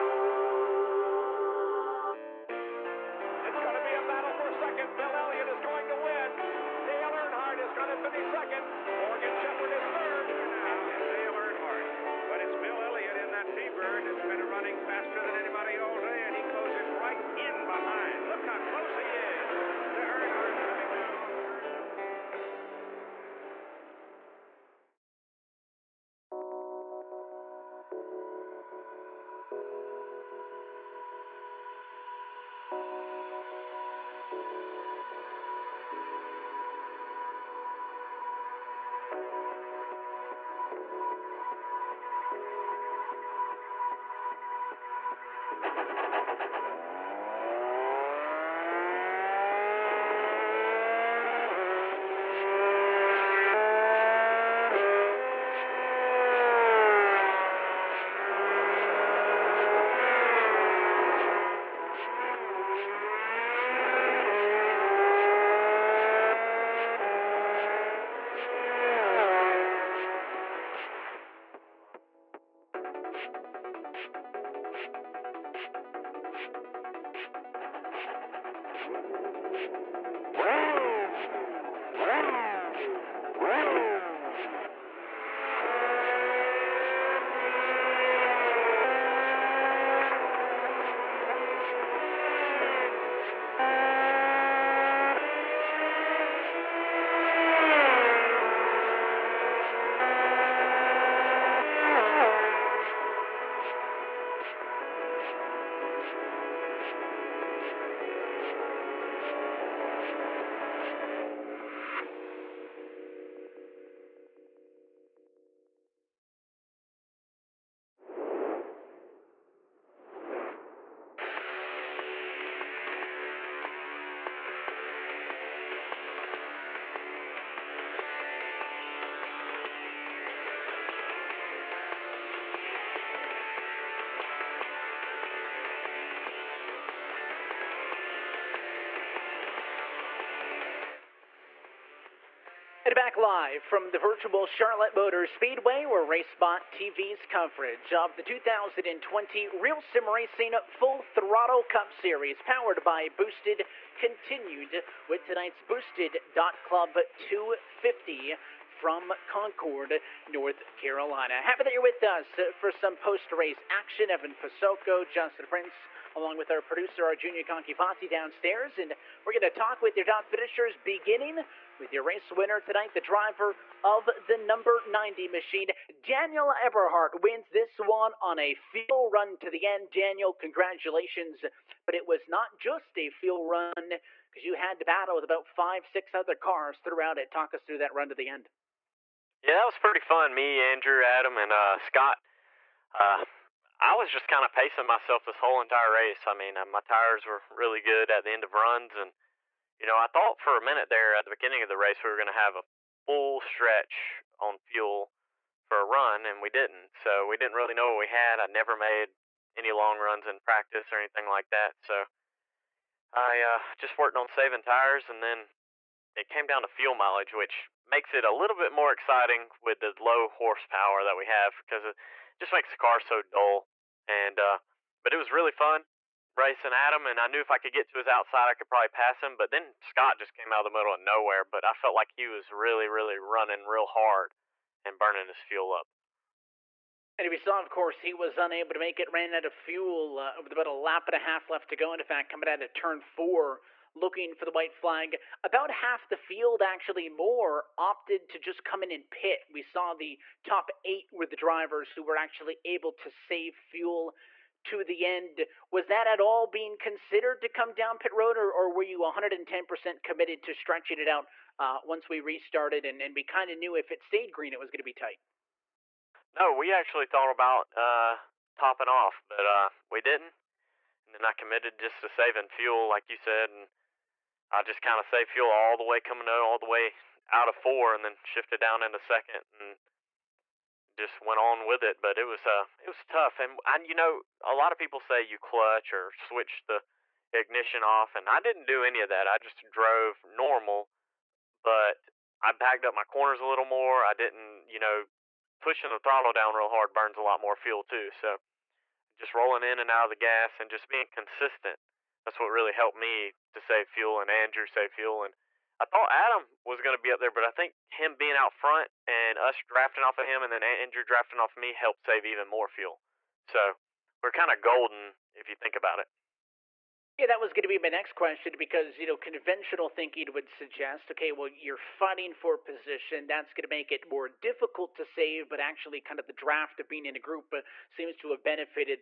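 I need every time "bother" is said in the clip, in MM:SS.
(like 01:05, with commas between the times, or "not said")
not said.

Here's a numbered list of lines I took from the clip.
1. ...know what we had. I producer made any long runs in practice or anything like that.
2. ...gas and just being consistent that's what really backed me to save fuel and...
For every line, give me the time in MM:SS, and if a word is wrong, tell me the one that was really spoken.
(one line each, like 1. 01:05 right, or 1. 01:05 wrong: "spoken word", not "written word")
1. 03:27 wrong: "never", not "producer"
2. 05:00 wrong: "helped", not "backed".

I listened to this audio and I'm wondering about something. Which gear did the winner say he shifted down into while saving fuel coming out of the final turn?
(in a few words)
Second.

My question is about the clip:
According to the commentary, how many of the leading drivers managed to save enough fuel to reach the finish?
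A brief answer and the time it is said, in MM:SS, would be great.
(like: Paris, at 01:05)
8, at 04:10.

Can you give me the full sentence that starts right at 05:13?
So we're kind of golden if you think about it.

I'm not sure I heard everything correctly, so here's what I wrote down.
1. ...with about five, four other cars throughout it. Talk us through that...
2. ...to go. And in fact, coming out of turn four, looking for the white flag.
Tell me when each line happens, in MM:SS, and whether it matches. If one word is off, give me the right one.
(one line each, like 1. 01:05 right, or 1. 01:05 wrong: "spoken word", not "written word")
1. 03:05 wrong: "six", not "four"
2. 04:01 right.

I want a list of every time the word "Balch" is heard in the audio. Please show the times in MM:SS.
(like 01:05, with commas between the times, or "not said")
not said.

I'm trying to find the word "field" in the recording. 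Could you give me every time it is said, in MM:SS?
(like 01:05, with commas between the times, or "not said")
02:58, 03:03, 04:06.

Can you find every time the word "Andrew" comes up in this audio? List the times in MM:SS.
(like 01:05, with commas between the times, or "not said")
03:10, 05:04, 05:10.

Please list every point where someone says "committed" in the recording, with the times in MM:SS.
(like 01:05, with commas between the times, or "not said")
04:20, 04:31.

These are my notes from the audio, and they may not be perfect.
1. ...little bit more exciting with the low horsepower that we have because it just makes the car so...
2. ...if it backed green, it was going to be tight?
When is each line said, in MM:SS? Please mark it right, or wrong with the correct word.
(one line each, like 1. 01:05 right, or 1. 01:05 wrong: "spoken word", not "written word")
1. 03:38 right
2. 04:23 wrong: "stayed", not "backed".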